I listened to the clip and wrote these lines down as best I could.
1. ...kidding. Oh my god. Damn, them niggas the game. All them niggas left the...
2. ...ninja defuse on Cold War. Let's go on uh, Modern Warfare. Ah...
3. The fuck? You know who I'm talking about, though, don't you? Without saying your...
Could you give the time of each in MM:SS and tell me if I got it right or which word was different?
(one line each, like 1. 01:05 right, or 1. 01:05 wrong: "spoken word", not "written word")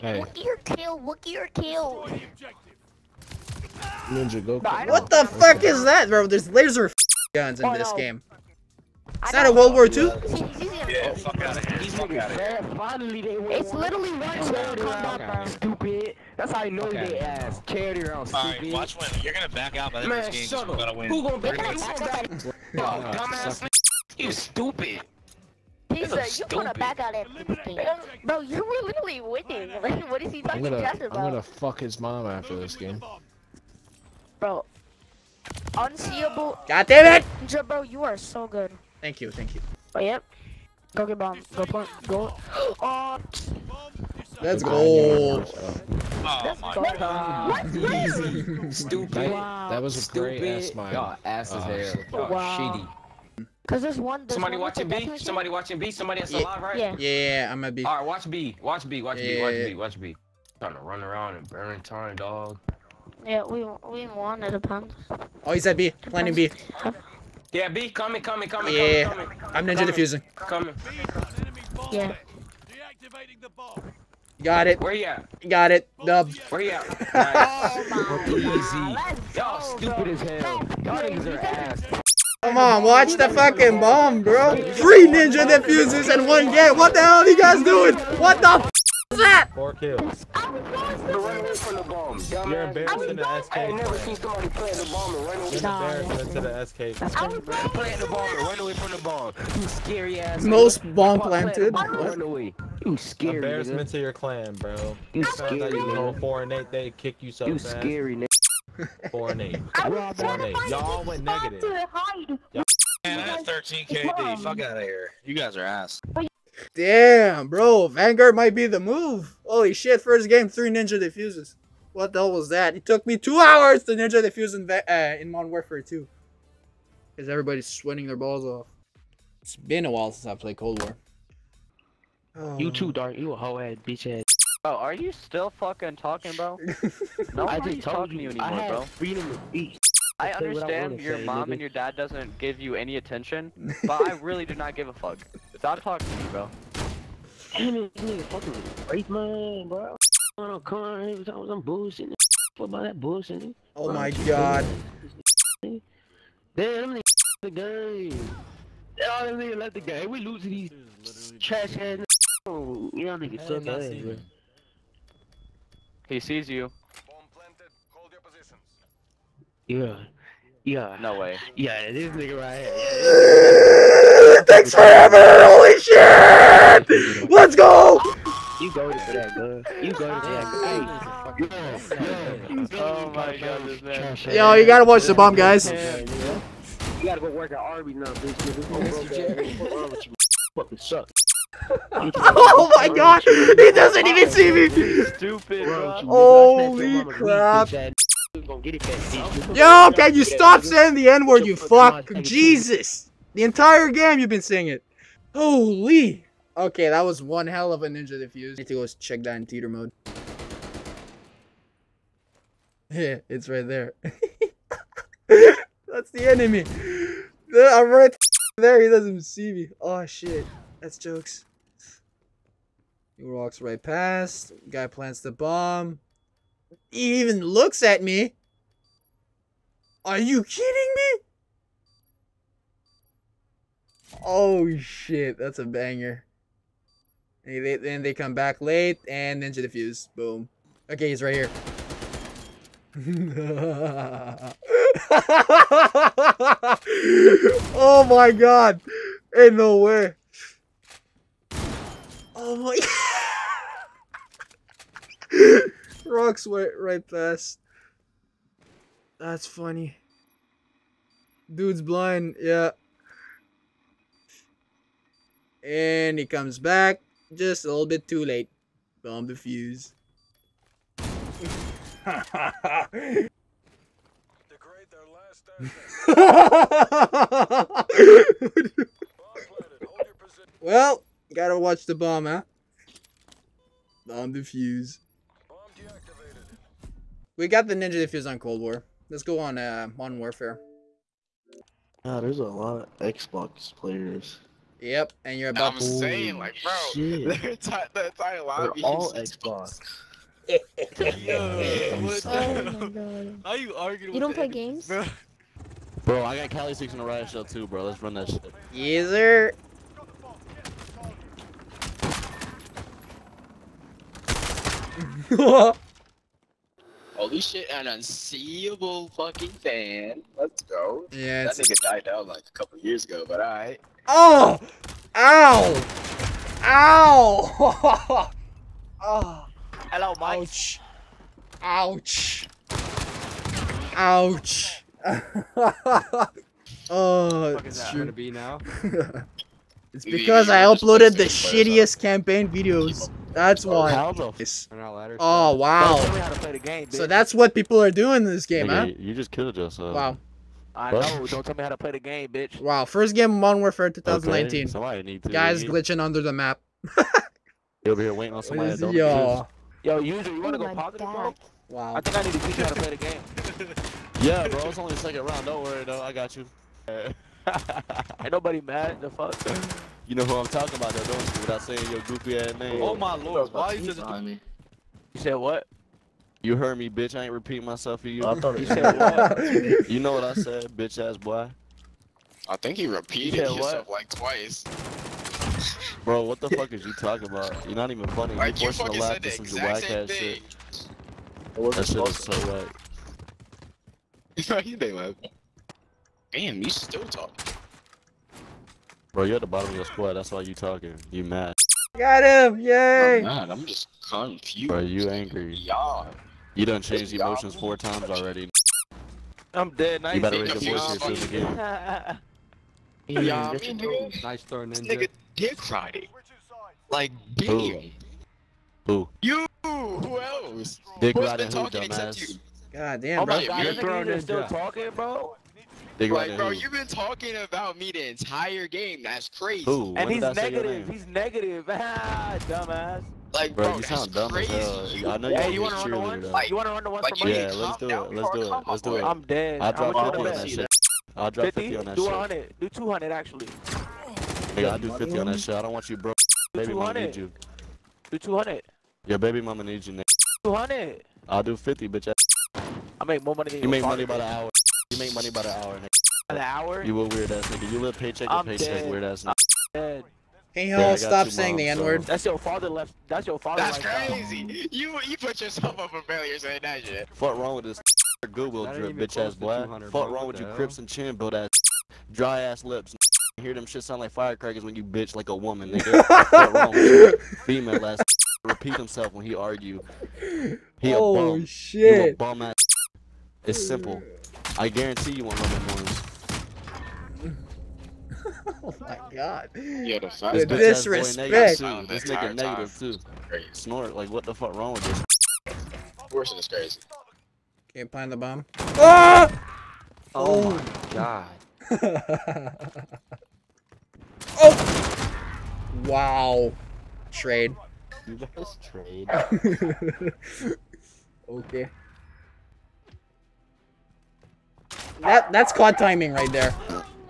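1. 02:32 wrong: "bullshitting", not "kidding"
2. 04:47 right
3. 06:09 right.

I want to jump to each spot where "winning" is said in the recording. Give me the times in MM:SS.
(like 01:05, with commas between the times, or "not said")
00:29.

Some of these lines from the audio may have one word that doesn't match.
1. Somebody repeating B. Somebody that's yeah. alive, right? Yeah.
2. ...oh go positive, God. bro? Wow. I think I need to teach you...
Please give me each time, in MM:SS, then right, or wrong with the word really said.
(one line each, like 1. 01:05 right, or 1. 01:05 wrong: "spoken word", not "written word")
1. 00:55 wrong: "watching", not "repeating"
2. 06:00 right.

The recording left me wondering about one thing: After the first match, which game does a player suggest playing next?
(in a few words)
Vanguard.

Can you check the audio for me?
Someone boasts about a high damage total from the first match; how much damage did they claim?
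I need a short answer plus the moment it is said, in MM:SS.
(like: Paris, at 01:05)
13k, at 01:53.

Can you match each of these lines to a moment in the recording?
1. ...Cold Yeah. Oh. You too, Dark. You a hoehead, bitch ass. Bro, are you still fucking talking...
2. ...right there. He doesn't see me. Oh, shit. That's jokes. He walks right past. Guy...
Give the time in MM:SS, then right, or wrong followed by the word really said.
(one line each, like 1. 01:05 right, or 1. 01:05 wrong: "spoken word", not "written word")
1. 02:10 wrong: "War", not "Yeah"
2. 03:37 right.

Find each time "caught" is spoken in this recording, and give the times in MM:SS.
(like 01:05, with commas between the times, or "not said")
not said.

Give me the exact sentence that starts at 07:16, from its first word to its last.
Like, you want to run to one for money?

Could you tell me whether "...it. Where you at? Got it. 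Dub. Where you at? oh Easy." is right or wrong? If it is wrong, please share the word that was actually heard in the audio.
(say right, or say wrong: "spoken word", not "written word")
right.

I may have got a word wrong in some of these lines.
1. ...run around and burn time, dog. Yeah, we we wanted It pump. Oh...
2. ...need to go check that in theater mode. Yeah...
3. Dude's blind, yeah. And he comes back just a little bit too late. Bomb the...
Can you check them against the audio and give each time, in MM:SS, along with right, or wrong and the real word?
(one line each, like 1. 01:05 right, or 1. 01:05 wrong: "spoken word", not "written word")
1. 01:00 right
2. 03:28 right
3. 04:21 right.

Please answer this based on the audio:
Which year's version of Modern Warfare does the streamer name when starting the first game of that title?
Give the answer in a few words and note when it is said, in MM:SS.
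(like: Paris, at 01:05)
2019, at 05:53.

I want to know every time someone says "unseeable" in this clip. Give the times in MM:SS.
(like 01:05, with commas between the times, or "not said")
00:35, 05:17.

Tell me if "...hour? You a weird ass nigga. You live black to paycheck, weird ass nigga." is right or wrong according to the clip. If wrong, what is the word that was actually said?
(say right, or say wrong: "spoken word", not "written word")
wrong: "paycheck", not "black".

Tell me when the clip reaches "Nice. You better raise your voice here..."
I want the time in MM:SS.
06:50.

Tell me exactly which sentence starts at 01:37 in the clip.
I was playing the bomb and run away from the bomb.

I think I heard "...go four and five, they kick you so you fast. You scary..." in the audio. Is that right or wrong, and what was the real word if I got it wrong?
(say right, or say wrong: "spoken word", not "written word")
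wrong: "eight", not "five".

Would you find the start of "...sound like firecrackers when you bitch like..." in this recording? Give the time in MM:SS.
07:53.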